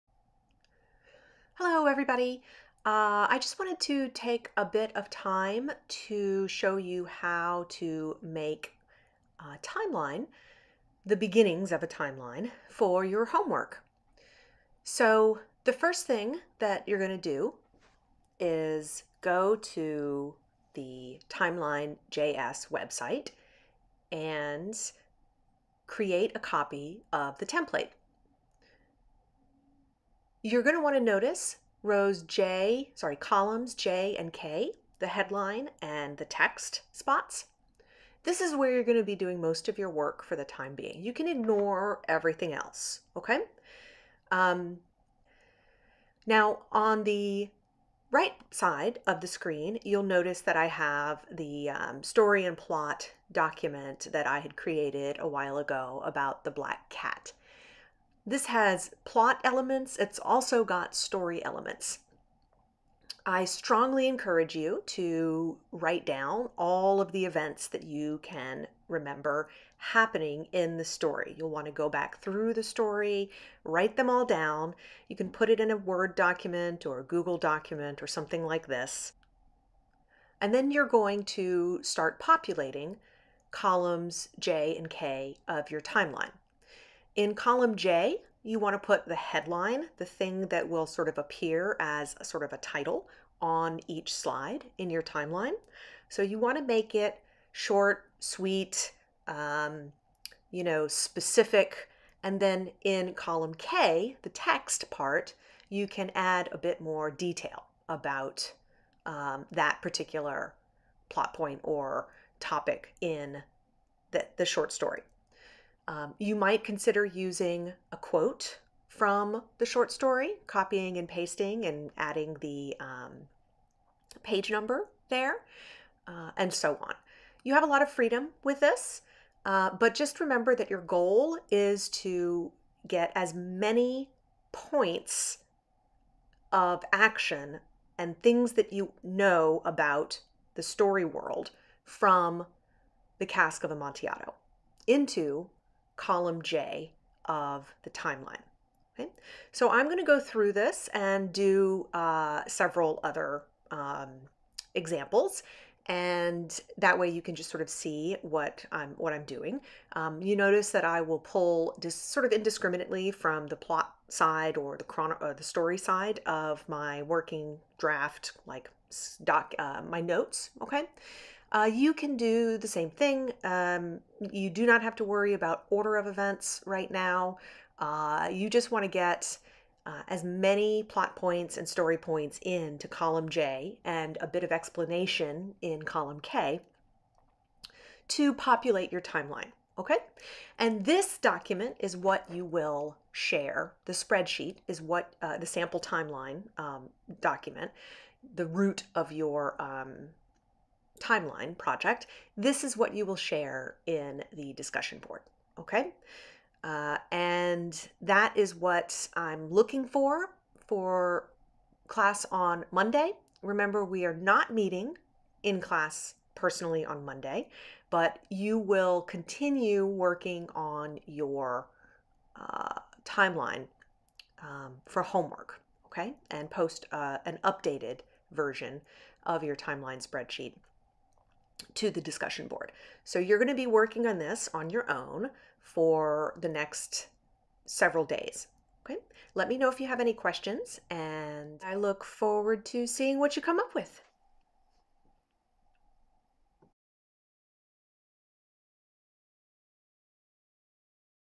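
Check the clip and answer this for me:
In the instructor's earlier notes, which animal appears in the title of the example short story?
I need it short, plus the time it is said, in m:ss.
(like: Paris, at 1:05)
black cat, at 0:56.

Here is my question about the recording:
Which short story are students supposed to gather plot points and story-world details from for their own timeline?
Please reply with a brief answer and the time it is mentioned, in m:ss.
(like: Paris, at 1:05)
The Cask of Amontillado, at 2:23.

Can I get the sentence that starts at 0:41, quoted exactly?
You can ignore everything else, okay?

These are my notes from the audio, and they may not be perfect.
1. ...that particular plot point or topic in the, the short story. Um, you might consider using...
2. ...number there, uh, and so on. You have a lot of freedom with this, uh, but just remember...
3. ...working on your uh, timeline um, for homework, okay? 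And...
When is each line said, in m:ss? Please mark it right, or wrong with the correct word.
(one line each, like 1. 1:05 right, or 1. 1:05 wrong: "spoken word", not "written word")
1. 1:49 right
2. 2:04 right
3. 3:39 right.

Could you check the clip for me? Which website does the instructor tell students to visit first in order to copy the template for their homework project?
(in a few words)
timeline.js.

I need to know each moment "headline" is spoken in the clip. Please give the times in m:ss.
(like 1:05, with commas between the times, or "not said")
0:35, 1:29.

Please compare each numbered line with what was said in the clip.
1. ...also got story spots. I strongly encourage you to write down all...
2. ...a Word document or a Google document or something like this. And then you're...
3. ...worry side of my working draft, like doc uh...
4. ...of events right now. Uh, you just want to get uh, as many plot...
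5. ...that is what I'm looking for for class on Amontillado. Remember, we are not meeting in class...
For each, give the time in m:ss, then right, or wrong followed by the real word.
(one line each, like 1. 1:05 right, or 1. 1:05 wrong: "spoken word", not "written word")
1. 1:00 wrong: "elements", not "spots"
2. 1:15 right
3. 2:45 wrong: "story", not "worry"
4. 2:55 right
5. 3:28 wrong: "Monday", not "Amontillado".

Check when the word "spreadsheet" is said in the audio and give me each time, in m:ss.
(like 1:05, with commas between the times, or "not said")
3:13, 3:50.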